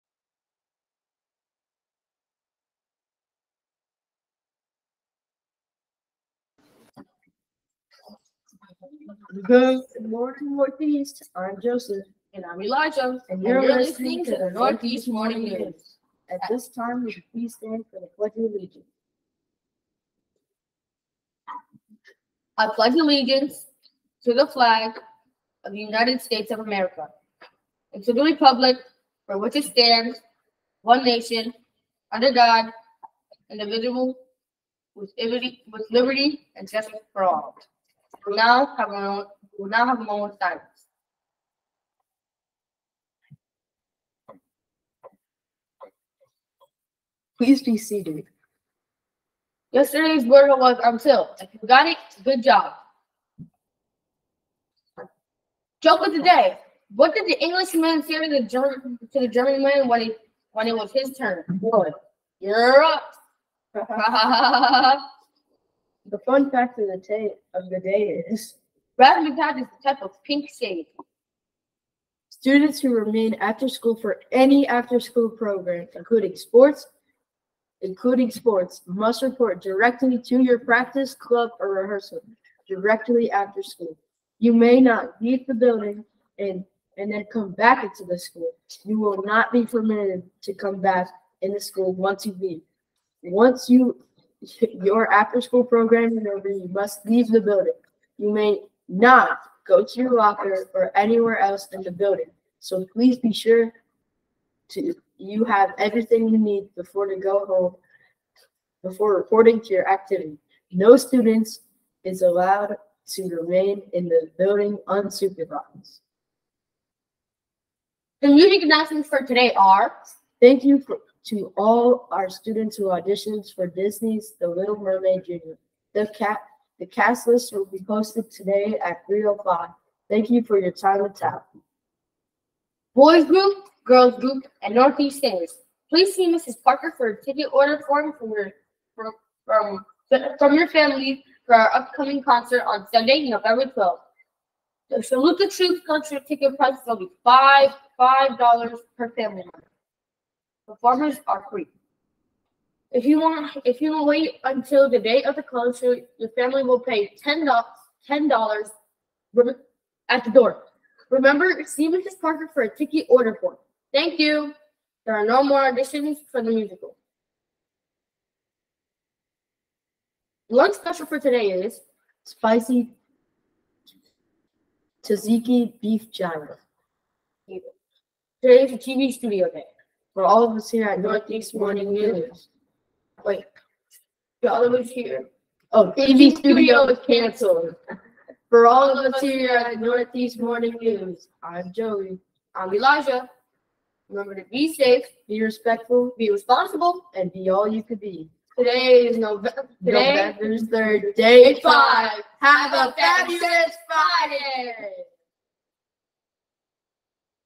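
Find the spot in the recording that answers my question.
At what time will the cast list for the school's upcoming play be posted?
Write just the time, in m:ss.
2:09.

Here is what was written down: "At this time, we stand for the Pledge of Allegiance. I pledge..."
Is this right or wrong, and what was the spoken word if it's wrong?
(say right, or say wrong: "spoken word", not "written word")
right.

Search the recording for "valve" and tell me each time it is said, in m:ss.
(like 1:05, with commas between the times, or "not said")
not said.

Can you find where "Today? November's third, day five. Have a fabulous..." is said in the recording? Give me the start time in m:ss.
3:19.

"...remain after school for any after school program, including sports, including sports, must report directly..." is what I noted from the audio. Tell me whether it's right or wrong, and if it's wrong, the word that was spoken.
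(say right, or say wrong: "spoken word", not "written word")
right.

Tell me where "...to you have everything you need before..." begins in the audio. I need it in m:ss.
1:44.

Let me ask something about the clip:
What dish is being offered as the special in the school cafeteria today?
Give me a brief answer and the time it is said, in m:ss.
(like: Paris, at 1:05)
spicy tzatziki beef gyro, at 2:52.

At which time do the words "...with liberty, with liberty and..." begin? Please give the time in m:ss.
0:34.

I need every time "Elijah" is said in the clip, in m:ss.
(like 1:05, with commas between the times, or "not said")
0:12, 3:12.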